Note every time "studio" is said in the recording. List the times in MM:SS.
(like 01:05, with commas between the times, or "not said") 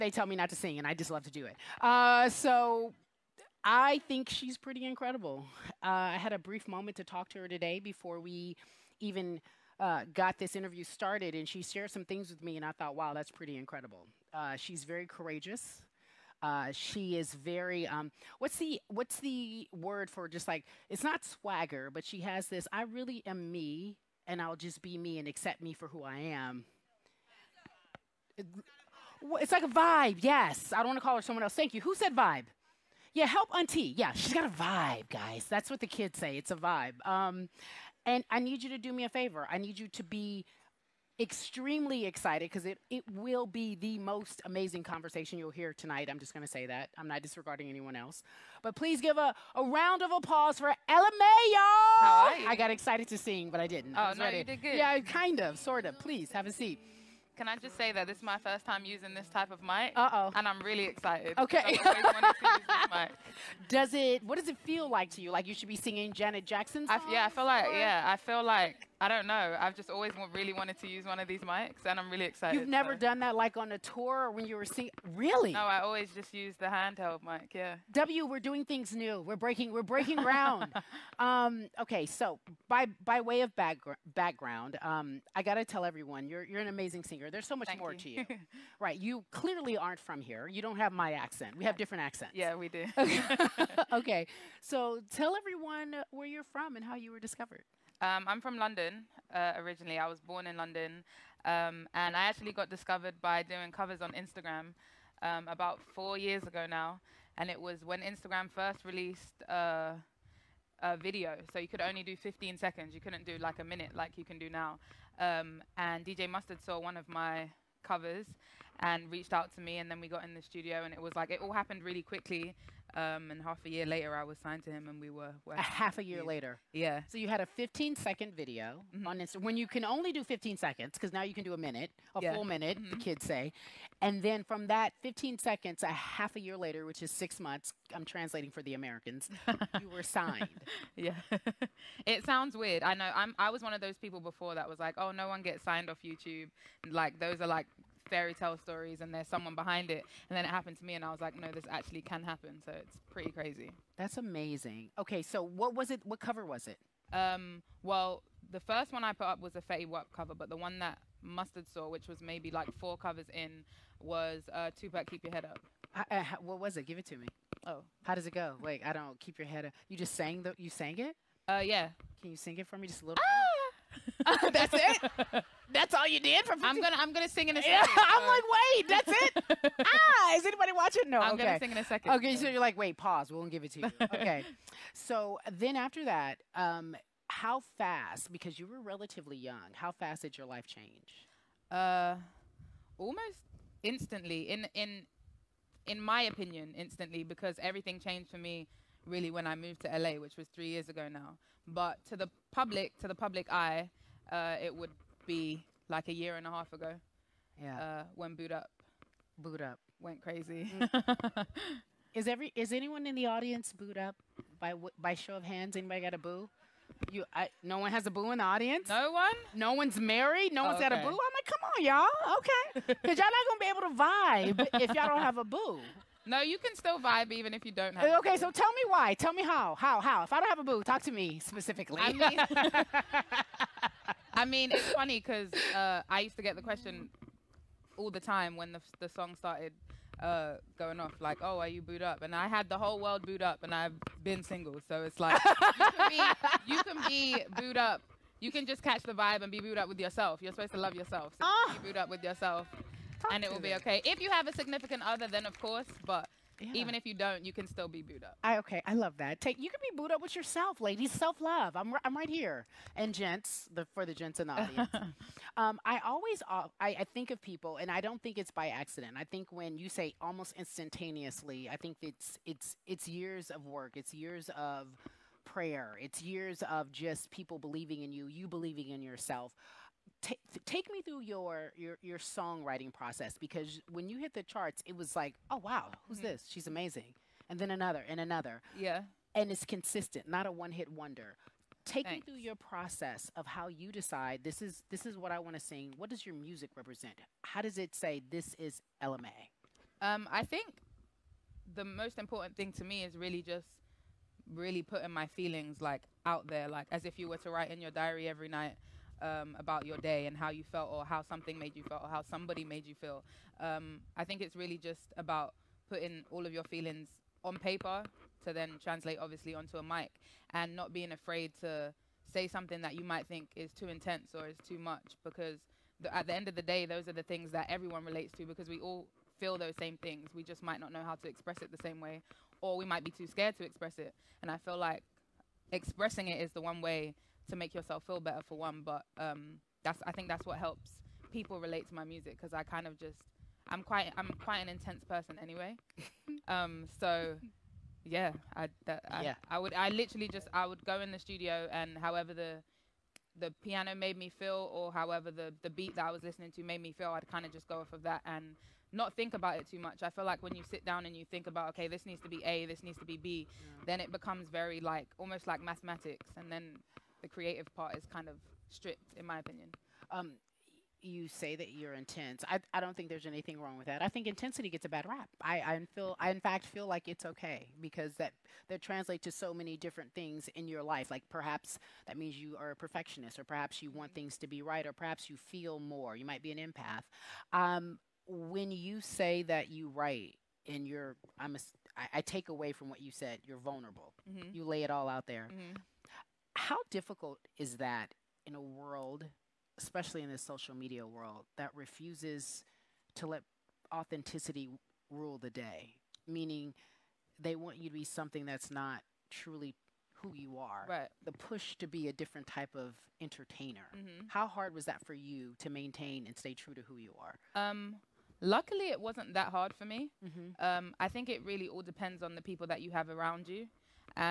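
02:00, 05:51.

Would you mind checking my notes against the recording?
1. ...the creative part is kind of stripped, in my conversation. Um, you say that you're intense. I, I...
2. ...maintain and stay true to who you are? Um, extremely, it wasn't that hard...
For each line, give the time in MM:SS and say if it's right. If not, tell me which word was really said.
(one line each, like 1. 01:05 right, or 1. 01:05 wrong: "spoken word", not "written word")
1. 06:07 wrong: "opinion", not "conversation"
2. 06:55 wrong: "luckily", not "extremely".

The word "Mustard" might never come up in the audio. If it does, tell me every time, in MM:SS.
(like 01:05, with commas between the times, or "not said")
01:56, 02:41.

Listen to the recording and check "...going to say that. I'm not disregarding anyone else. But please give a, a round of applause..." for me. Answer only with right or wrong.
right.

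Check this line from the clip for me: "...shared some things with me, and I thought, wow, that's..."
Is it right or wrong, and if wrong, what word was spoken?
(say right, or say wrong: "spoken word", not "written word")
right.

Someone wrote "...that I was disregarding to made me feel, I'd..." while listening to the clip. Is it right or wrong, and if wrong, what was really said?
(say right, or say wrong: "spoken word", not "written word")
wrong: "listening", not "disregarding".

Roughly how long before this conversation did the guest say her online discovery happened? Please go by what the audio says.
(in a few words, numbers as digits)
about 4 years ago.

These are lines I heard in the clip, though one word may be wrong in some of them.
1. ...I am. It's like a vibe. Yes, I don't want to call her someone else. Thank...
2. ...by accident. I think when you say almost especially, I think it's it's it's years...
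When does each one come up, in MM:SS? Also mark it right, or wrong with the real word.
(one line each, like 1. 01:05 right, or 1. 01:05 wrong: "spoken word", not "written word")
1. 00:26 right
2. 04:28 wrong: "instantaneously", not "especially".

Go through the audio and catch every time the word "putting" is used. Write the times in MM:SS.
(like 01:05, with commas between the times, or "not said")
05:04, 05:15.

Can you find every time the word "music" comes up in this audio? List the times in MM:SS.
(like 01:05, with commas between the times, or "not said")
04:56, 05:42.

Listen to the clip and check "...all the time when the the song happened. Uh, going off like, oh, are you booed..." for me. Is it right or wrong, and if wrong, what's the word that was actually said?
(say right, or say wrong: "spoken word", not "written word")
wrong: "started", not "happened".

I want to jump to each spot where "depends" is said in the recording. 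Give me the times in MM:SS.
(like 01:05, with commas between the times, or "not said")
07:01.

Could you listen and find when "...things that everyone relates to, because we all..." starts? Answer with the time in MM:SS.
05:27.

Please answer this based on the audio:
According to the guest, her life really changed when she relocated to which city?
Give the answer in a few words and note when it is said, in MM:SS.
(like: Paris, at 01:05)
LA, at 03:19.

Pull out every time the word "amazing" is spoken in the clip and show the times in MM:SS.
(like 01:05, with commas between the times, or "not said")
00:44, 01:26, 02:34, 04:46.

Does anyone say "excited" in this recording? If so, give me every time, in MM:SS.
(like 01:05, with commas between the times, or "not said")
00:42, 00:52, 01:00, 01:12.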